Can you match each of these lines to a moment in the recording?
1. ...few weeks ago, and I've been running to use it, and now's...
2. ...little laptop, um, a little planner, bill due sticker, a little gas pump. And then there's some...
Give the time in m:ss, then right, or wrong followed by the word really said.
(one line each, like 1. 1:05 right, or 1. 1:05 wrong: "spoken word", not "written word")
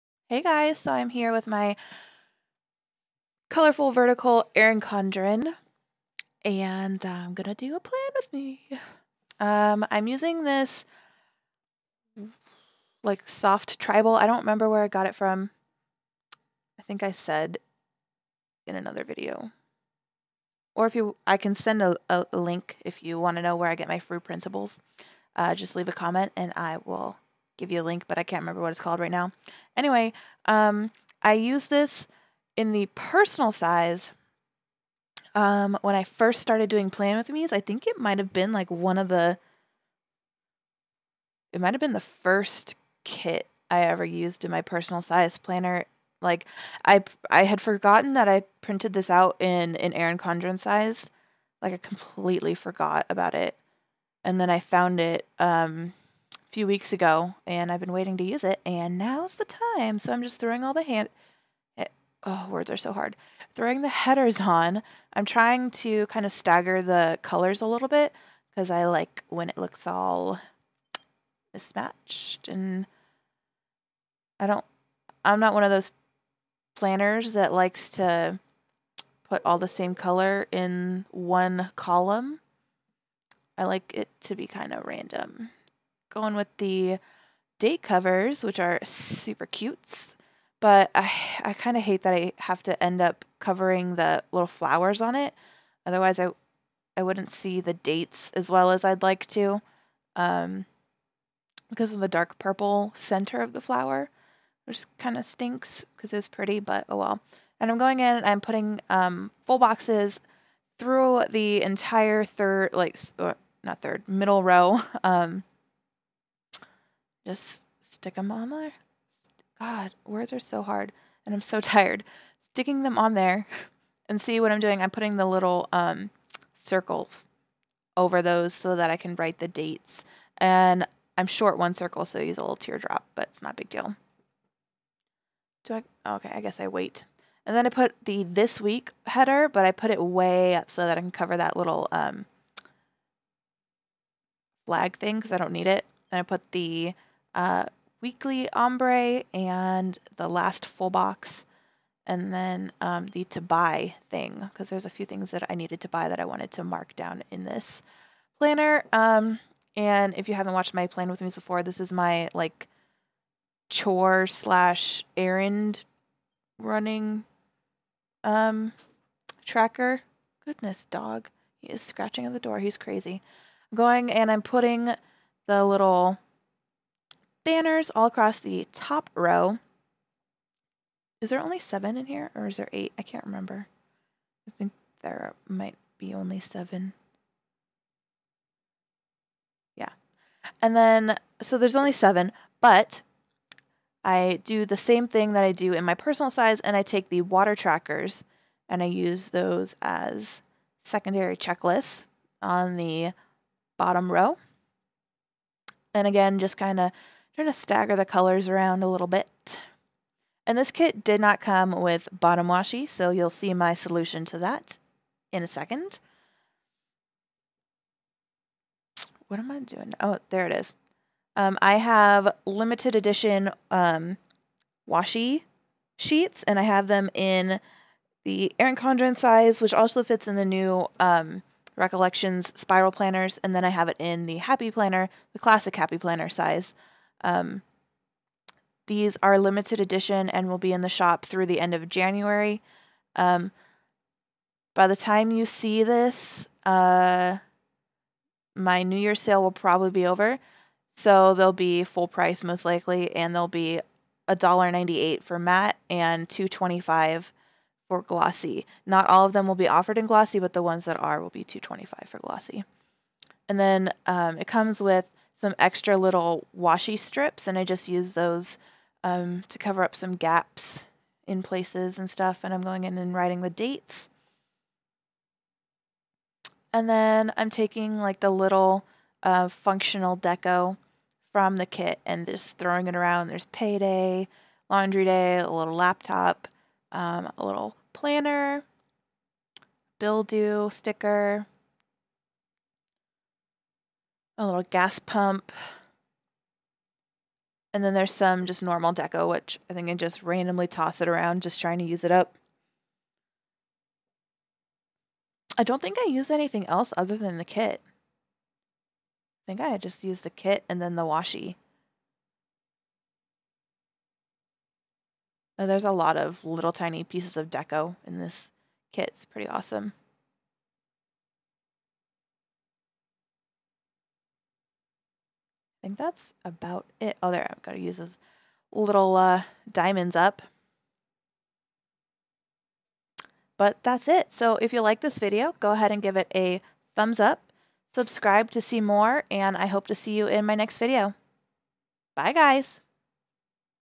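1. 0:56 wrong: "waiting", not "running"
2. 4:45 right.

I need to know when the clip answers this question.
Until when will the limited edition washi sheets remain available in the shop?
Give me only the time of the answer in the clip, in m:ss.
4:01.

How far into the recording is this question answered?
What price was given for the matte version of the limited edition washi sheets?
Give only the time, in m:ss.
4:14.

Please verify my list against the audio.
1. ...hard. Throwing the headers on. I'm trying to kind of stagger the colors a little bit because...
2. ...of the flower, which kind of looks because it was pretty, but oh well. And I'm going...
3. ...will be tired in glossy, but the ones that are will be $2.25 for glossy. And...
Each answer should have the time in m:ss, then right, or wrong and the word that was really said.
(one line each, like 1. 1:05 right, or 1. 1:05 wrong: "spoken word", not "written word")
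1. 1:02 right
2. 1:43 wrong: "stinks", not "looks"
3. 4:19 wrong: "offered", not "tired".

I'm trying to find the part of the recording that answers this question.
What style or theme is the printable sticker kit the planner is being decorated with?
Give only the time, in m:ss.
0:13.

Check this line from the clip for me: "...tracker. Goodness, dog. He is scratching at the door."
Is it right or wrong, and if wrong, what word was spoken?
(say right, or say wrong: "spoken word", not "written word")
right.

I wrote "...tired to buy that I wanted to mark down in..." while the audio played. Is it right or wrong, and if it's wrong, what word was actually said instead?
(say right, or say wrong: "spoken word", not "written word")
wrong: "needed", not "tired".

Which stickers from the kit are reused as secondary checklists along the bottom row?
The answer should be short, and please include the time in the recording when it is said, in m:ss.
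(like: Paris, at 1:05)
Water trackers, at 3:17.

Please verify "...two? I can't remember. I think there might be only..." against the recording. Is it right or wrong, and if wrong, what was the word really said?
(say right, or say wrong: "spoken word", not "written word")
wrong: "eight", not "two".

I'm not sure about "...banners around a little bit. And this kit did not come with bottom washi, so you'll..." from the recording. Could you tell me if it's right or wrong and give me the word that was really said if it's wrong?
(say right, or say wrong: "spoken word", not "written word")
wrong: "colors", not "banners".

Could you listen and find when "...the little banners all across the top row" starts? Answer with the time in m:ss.
2:55.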